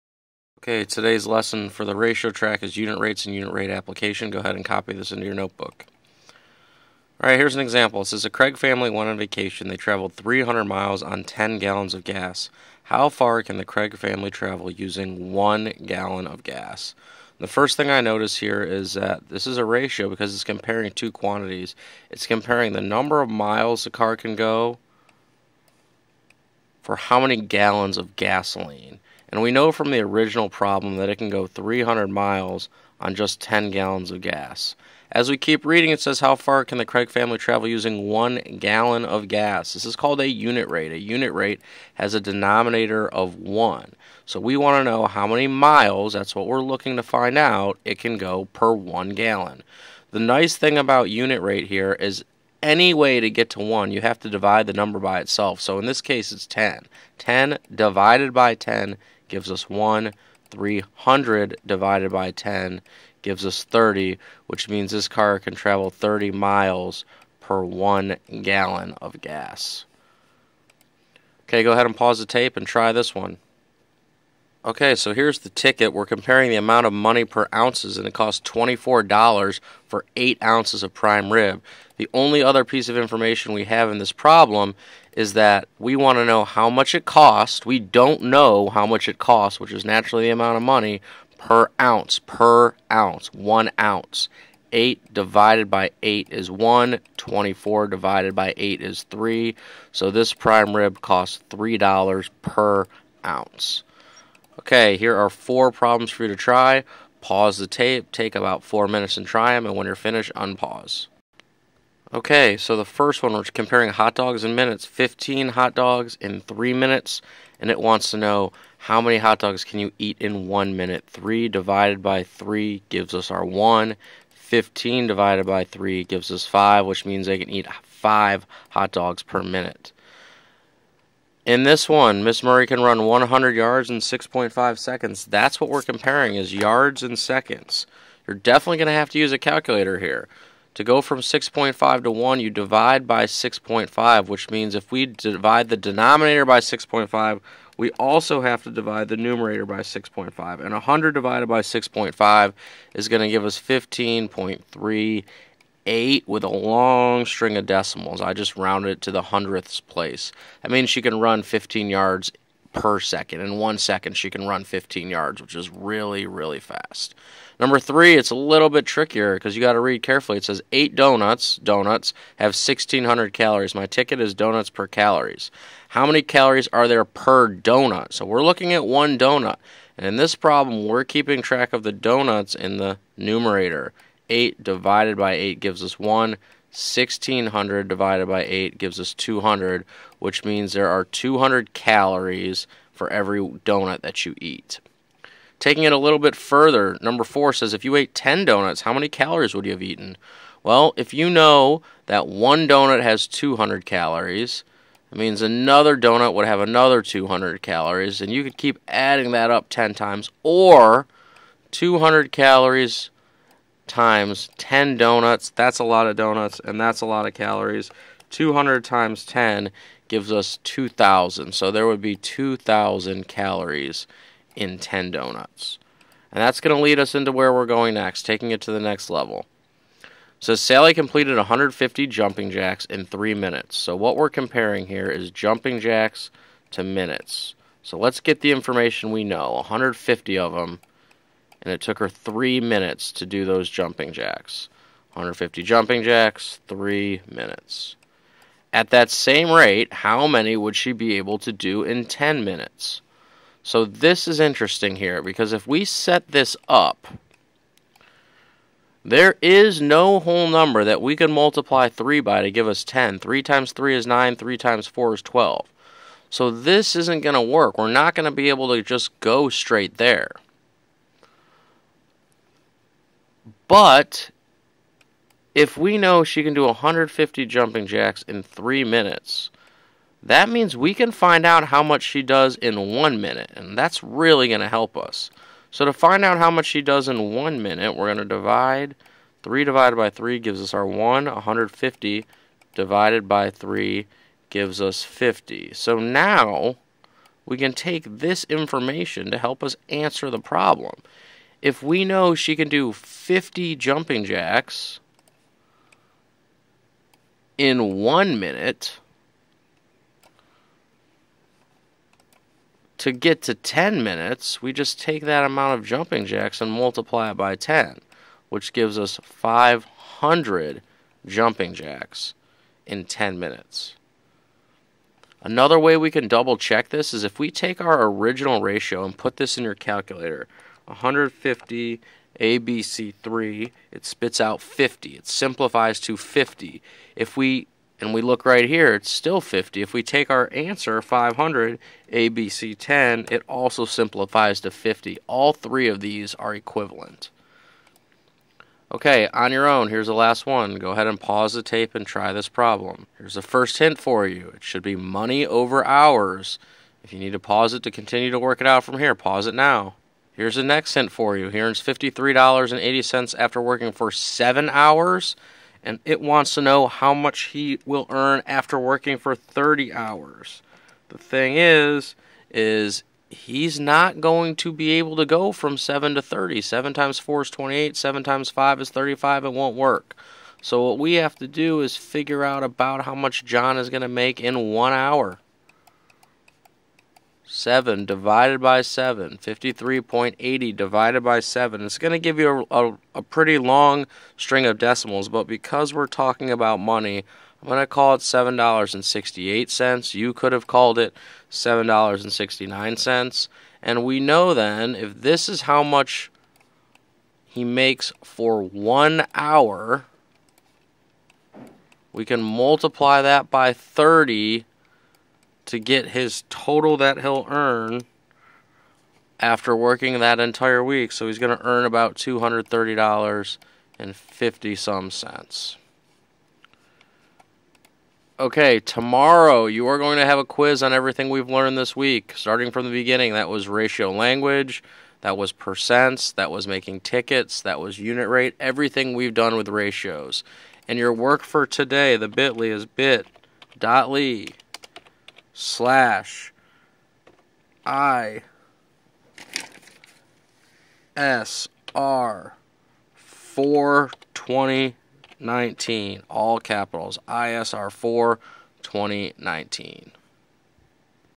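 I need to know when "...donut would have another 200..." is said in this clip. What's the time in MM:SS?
03:25.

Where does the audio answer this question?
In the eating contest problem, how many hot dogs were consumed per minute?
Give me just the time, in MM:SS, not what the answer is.
02:07.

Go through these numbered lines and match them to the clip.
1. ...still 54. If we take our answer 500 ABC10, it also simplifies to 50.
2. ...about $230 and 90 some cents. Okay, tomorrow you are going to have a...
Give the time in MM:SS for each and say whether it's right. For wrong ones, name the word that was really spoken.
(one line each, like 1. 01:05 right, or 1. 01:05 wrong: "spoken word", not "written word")
1. 05:39 wrong: "50", not "54"
2. 07:01 wrong: "50", not "90".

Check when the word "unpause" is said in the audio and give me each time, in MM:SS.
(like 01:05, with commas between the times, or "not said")
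01:50.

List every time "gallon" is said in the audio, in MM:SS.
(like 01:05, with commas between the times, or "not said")
00:11, 00:15, 00:27, 00:33, 00:38, 00:49, 01:08.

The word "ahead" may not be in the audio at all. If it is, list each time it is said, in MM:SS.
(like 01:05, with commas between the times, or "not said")
00:04, 01:11, 05:50.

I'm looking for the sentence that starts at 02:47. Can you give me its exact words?
Number three, it's a little bit trickier because you got to read carefully.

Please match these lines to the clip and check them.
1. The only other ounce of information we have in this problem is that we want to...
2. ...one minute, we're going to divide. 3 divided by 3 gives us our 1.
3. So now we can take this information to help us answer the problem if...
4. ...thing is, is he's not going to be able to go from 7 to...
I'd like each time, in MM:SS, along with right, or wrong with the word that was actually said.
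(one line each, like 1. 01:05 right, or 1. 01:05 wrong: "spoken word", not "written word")
1. 01:21 wrong: "piece", not "ounce"
2. 04:47 right
3. 04:55 right
4. 06:11 right.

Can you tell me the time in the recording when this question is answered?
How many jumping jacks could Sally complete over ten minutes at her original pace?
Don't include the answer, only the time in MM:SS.
05:19.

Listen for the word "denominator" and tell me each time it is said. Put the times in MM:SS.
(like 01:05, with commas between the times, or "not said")
00:42, 02:25.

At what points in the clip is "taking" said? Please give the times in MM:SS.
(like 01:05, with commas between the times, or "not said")
03:15, 03:48.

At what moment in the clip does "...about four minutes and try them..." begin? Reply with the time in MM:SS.
01:48.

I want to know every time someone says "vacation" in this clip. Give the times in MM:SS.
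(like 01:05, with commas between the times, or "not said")
00:09.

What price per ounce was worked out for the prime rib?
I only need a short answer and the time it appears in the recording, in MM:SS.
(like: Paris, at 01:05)
$3, at 01:41.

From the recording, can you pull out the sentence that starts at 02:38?
I just rounded it to the hundredths place.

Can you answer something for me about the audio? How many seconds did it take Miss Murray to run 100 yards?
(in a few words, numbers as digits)
6.5 seconds.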